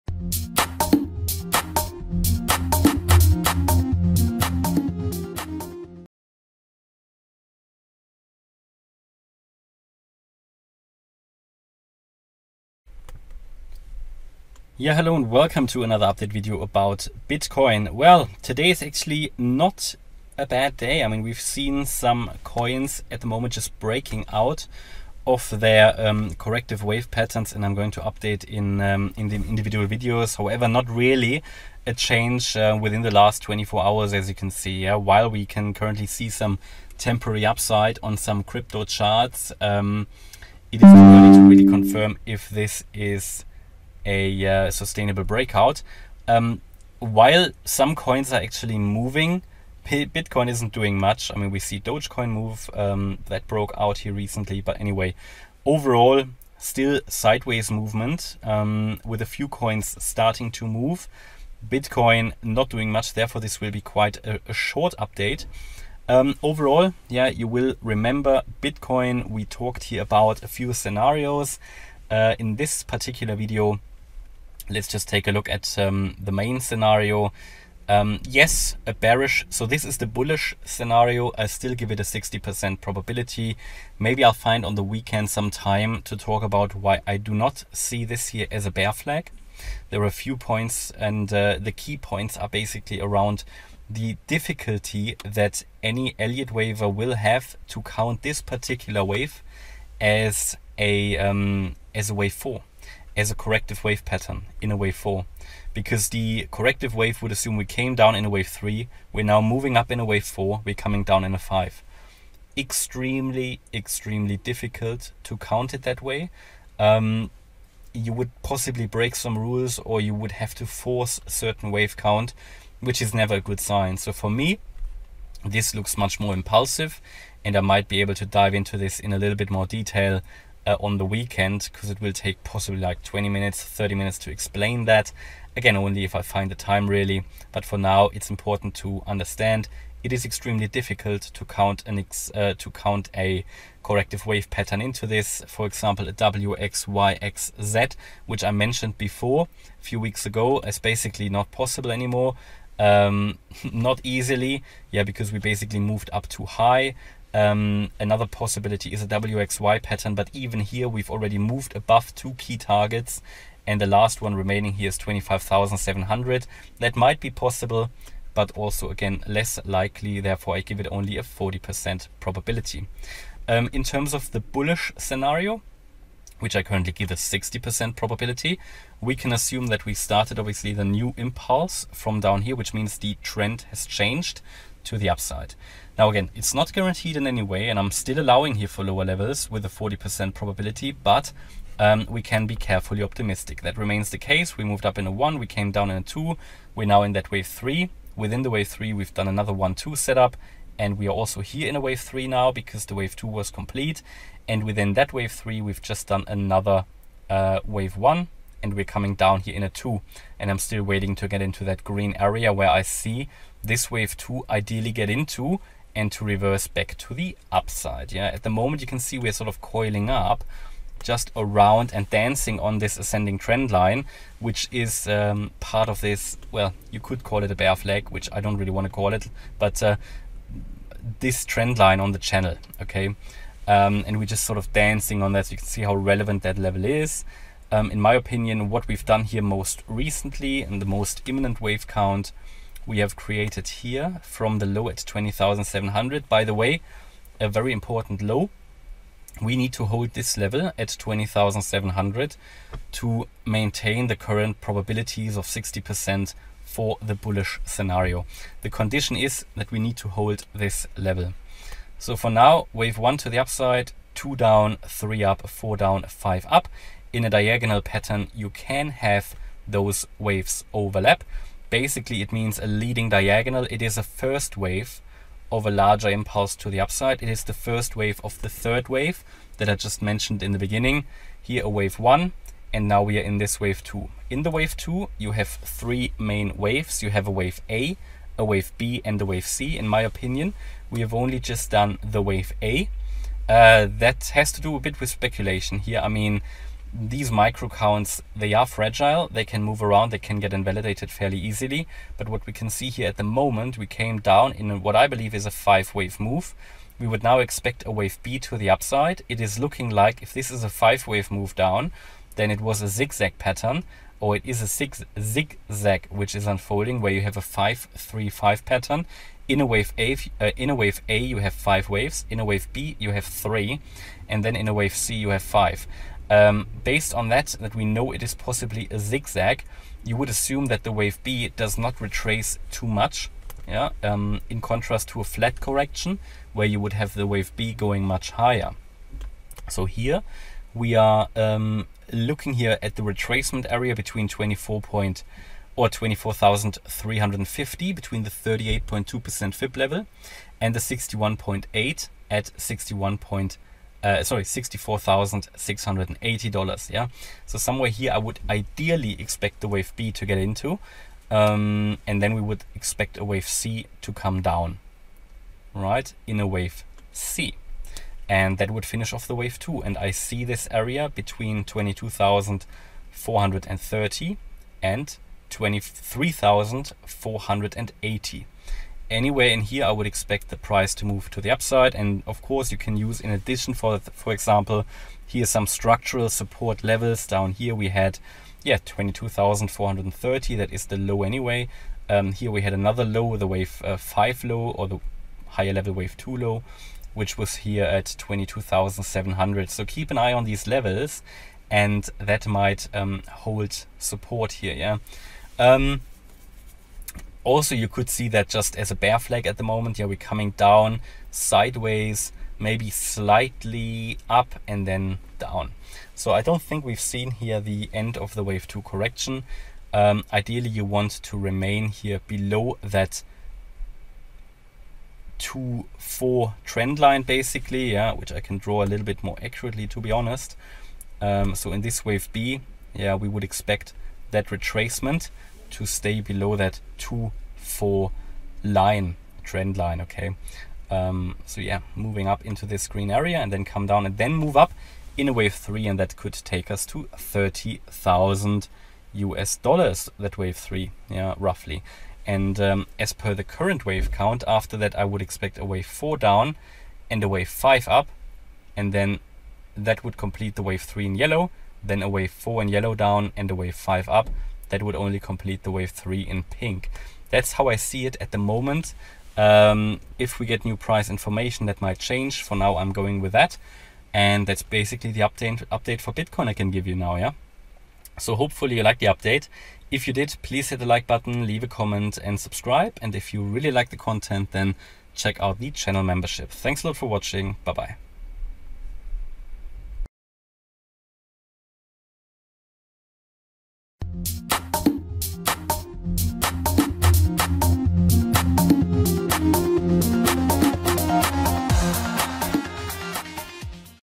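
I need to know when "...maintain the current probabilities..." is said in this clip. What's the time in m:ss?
4:13.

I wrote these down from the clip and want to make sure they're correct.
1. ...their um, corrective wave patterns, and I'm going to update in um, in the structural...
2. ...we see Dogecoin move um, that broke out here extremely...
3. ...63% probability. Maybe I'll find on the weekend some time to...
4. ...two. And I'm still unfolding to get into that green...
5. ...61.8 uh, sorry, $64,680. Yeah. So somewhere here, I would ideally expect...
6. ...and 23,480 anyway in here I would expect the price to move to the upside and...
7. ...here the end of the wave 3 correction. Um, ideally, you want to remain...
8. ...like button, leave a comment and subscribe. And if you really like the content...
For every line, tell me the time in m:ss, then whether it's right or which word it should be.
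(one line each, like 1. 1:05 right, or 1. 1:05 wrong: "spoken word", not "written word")
1. 0:25 wrong: "individual", not "structural"
2. 0:51 wrong: "recently", not "extremely"
3. 1:22 wrong: "60", not "63"
4. 3:29 wrong: "waiting", not "unfolding"
5. 5:52 right
6. 6:14 right
7. 6:57 wrong: "2", not "3"
8. 8:00 right.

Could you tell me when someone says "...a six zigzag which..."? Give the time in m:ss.
5:14.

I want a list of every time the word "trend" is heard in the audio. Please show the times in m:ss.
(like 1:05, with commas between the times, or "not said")
3:03, 3:43, 3:51, 7:06, 7:19.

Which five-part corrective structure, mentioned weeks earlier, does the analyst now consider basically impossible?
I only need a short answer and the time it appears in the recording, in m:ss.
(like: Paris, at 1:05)
WXYXZ, at 2:26.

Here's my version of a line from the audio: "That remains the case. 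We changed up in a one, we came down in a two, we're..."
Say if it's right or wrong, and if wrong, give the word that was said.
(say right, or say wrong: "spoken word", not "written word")
wrong: "moved", not "changed".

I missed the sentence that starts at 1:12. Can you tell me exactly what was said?
Uh, in this particular video, let's just take a look at um, the main scenario.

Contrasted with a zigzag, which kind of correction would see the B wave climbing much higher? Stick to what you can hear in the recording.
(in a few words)
flat correction.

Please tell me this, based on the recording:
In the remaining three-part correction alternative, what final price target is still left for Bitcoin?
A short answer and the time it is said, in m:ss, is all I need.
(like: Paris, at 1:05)
25,700, at 2:44.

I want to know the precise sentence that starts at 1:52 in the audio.
Extremely, extremely difficult to count it that way.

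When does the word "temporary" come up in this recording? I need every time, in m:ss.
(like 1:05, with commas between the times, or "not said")
0:36.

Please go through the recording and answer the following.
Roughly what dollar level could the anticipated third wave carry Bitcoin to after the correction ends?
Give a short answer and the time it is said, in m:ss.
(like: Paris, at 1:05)
30,000 US dollars, at 7:27.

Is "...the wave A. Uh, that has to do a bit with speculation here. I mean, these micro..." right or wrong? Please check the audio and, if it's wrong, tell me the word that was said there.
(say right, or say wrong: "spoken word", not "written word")
right.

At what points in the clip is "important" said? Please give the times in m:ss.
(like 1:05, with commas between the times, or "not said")
2:18, 4:07.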